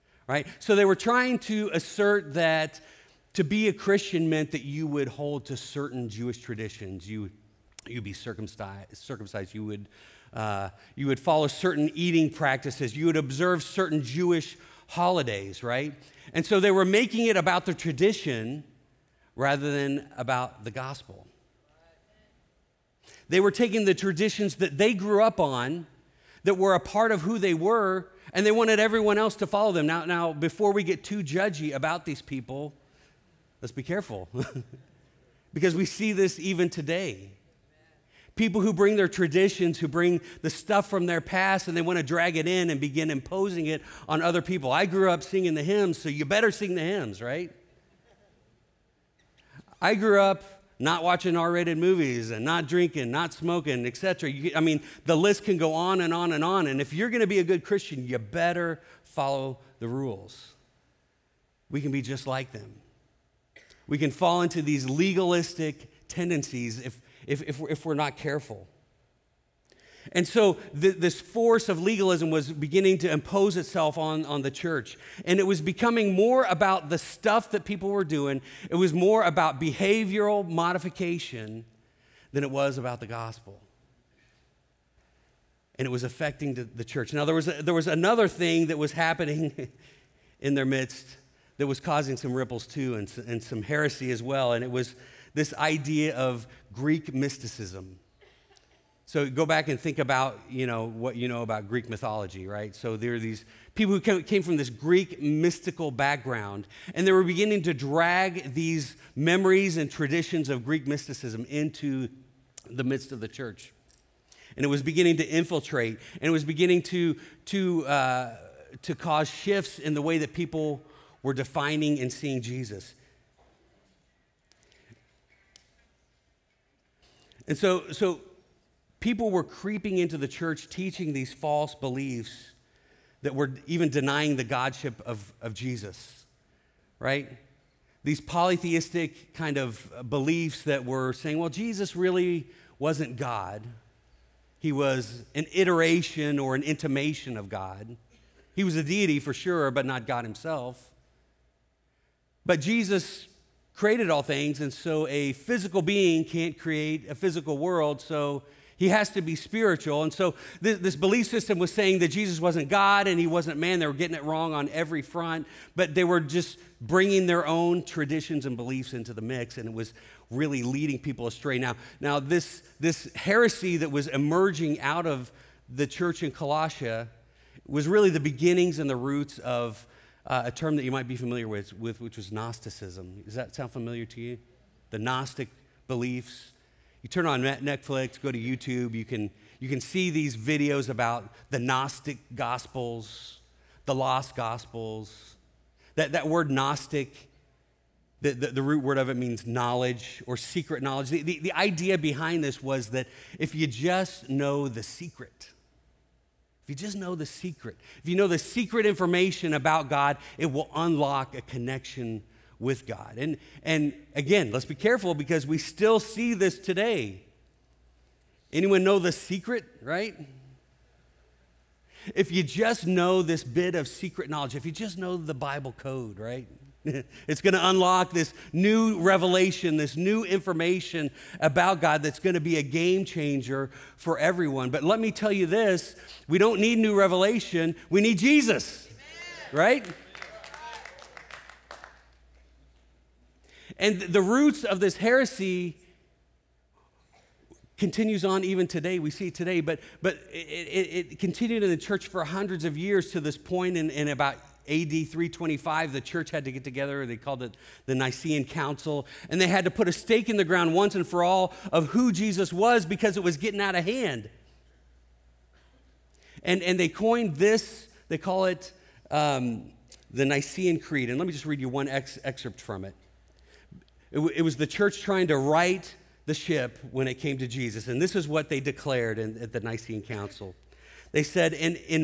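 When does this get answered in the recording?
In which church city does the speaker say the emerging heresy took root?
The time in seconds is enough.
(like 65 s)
176 s.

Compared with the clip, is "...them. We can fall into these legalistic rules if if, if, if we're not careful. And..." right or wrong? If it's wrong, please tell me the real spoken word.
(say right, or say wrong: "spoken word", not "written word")
wrong: "tendencies", not "rules".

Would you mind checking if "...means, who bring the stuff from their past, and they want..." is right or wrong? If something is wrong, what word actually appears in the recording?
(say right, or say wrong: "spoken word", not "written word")
wrong: "traditions", not "means".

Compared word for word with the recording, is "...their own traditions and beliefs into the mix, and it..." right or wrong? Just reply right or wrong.
right.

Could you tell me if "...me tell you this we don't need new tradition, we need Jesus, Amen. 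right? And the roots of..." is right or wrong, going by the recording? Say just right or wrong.
wrong.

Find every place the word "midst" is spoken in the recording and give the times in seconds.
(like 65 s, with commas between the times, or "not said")
90 s, 112 s.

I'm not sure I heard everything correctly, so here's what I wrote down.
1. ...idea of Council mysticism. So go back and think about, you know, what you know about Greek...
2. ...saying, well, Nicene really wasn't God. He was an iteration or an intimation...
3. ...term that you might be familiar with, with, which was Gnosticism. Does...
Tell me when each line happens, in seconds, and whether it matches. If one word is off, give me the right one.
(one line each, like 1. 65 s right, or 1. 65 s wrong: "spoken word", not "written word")
1. 95 s wrong: "Greek", not "Council"
2. 141 s wrong: "Jesus", not "Nicene"
3. 180 s right.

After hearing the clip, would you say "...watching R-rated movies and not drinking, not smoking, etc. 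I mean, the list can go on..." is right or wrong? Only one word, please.
right.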